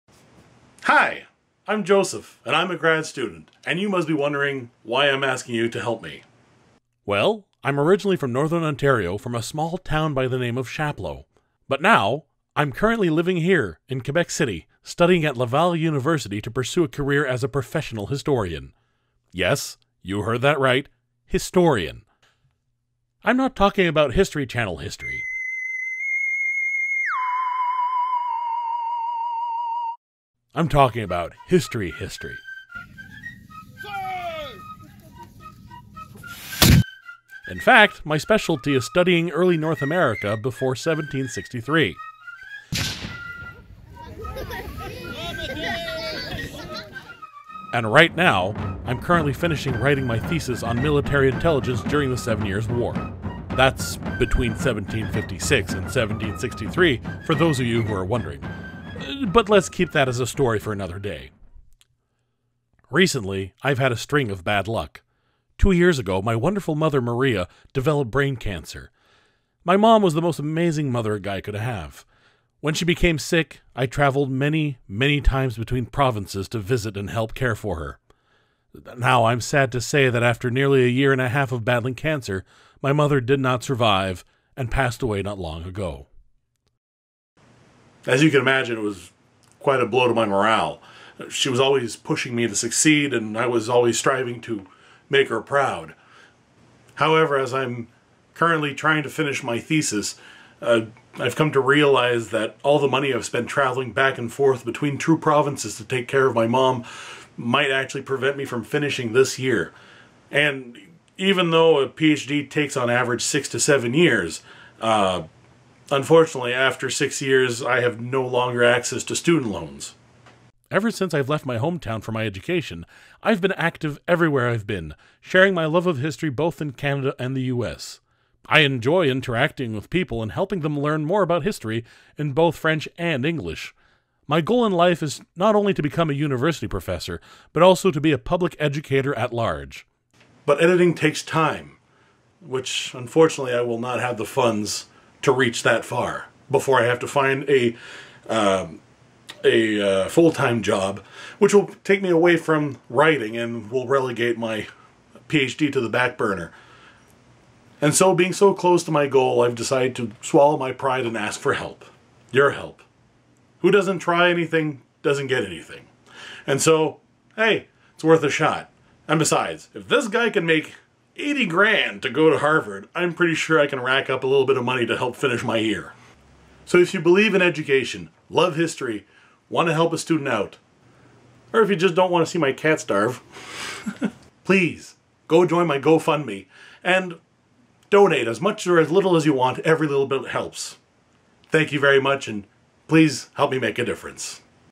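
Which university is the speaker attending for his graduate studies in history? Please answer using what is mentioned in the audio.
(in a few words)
Laval University.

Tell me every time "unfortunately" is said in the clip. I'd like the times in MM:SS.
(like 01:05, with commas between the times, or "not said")
01:55, 02:22.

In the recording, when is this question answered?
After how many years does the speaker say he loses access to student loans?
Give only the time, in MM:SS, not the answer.
01:56.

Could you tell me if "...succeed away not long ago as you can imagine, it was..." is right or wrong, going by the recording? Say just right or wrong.
wrong.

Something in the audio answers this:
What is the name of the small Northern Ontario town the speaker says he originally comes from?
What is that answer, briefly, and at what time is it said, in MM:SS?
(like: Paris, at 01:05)
Chapleau, at 00:10.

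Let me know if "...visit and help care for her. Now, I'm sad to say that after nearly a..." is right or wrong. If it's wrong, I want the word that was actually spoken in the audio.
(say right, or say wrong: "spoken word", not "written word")
right.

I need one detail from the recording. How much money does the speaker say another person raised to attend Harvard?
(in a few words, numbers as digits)
80 grand.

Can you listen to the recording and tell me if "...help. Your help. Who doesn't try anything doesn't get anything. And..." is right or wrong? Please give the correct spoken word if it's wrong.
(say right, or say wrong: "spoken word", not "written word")
right.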